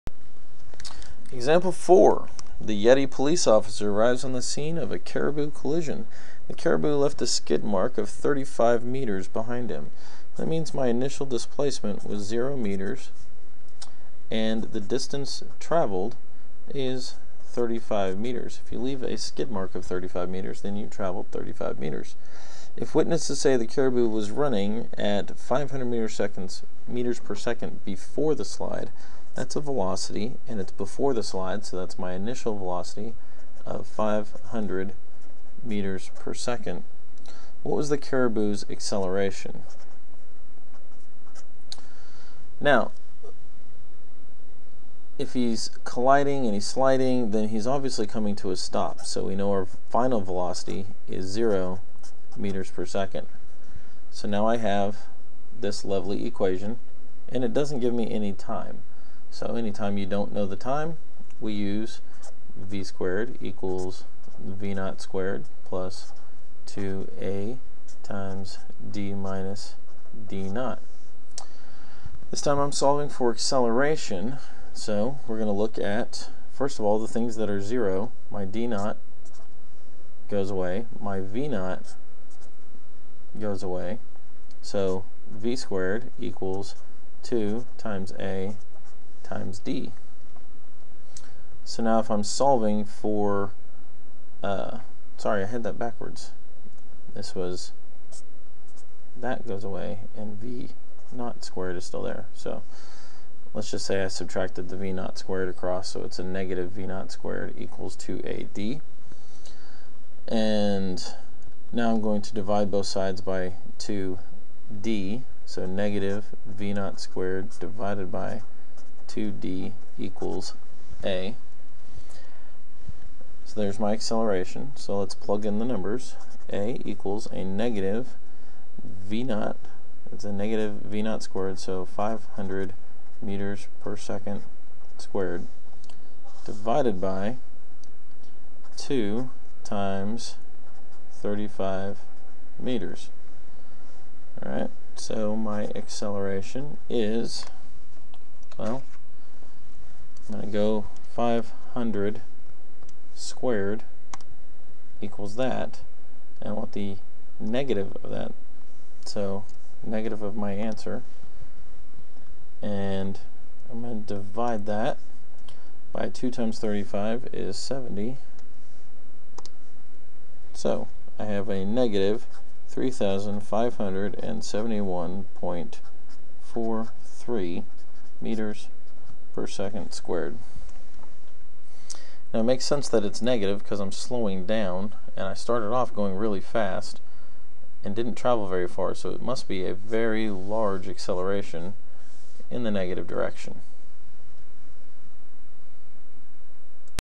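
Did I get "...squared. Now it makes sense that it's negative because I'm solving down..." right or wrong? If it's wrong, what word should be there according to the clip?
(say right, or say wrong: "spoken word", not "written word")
wrong: "slowing", not "solving".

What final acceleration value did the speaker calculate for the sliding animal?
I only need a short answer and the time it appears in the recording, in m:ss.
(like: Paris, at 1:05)
-3,571.43 meters per second squared, at 2:51.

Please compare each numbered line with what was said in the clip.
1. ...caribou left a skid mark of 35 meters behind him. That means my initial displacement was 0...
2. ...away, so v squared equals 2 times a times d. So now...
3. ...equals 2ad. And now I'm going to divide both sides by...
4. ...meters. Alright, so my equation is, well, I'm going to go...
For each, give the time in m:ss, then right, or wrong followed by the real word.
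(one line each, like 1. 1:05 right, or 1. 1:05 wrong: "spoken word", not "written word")
1. 0:06 right
2. 1:23 right
3. 1:47 right
4. 2:22 wrong: "acceleration", not "equation".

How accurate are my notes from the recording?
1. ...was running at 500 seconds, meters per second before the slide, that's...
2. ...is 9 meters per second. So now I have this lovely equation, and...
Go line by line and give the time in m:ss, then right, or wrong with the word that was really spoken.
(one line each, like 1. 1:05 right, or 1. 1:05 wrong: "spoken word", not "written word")
1. 0:24 right
2. 0:51 wrong: "0", not "9".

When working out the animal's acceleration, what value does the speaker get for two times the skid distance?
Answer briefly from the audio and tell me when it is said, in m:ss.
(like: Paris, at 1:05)
70, at 2:47.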